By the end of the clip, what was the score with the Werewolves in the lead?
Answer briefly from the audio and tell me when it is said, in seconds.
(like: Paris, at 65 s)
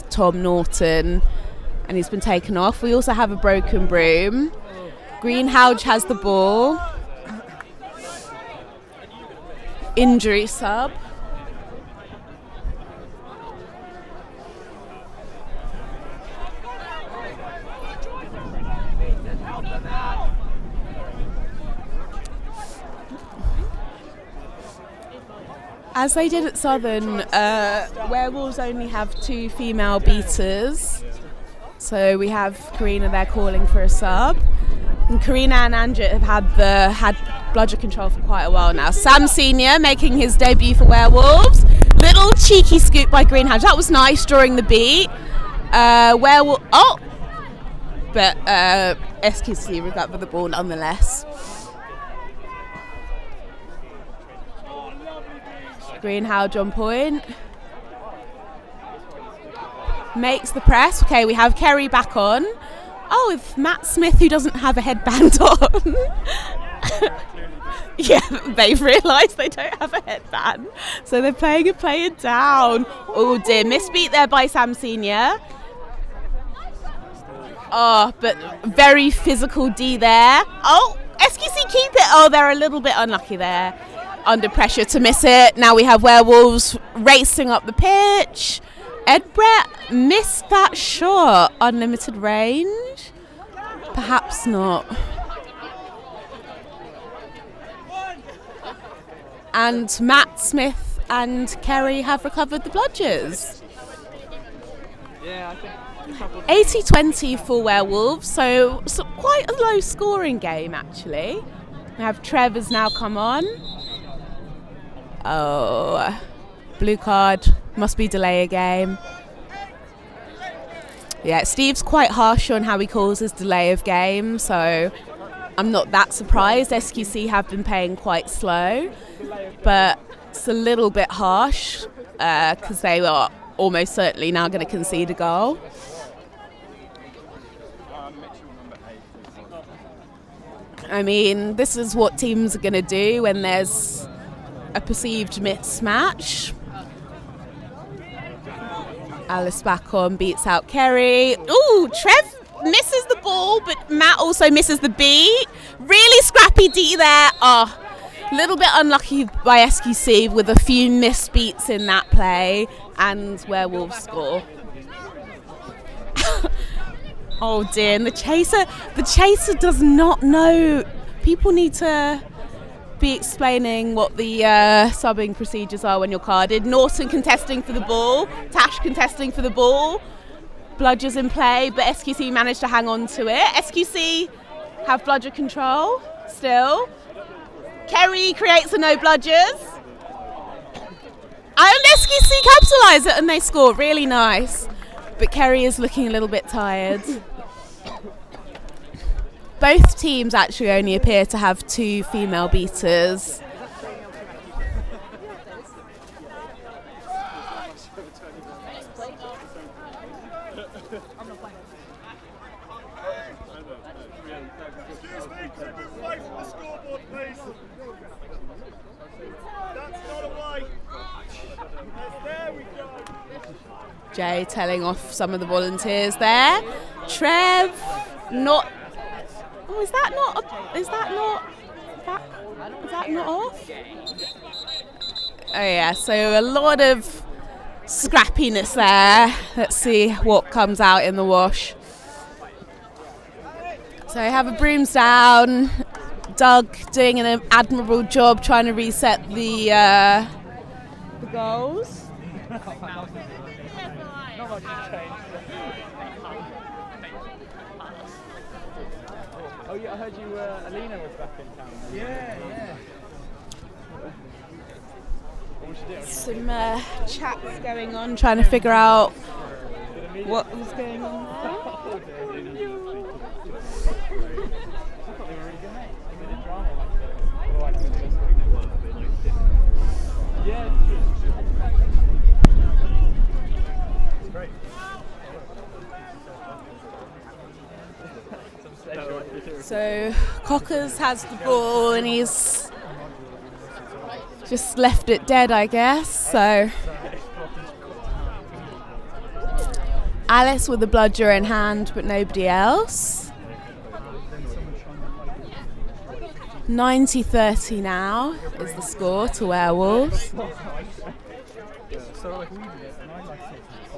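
90-30, at 306 s.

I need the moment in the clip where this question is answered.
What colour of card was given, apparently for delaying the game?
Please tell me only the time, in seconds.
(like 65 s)
116 s.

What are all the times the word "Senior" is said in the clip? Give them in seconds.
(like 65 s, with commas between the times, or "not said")
39 s, 74 s.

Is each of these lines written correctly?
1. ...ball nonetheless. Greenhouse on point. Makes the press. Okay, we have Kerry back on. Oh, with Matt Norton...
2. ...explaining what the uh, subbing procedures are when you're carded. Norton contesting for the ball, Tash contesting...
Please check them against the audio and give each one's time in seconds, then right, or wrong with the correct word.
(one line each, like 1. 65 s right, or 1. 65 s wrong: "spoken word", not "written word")
1. 50 s wrong: "Smith", not "Norton"
2. 173 s right.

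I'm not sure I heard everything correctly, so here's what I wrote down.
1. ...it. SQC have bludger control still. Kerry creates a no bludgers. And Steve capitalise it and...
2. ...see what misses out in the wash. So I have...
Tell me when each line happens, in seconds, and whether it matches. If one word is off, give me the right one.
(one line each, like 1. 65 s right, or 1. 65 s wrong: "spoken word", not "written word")
1. 183 s wrong: "SQC", not "Steve"
2. 239 s wrong: "comes", not "misses".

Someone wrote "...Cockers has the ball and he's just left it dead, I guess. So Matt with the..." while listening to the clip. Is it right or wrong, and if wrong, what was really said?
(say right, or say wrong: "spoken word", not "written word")
wrong: "Alice", not "Matt".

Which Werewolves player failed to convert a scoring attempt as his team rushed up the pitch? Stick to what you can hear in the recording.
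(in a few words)
Ed Brett.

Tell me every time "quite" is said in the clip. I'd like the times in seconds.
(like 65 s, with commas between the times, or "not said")
38 s, 109 s, 121 s, 127 s.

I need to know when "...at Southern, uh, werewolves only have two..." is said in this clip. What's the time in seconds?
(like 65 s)
26 s.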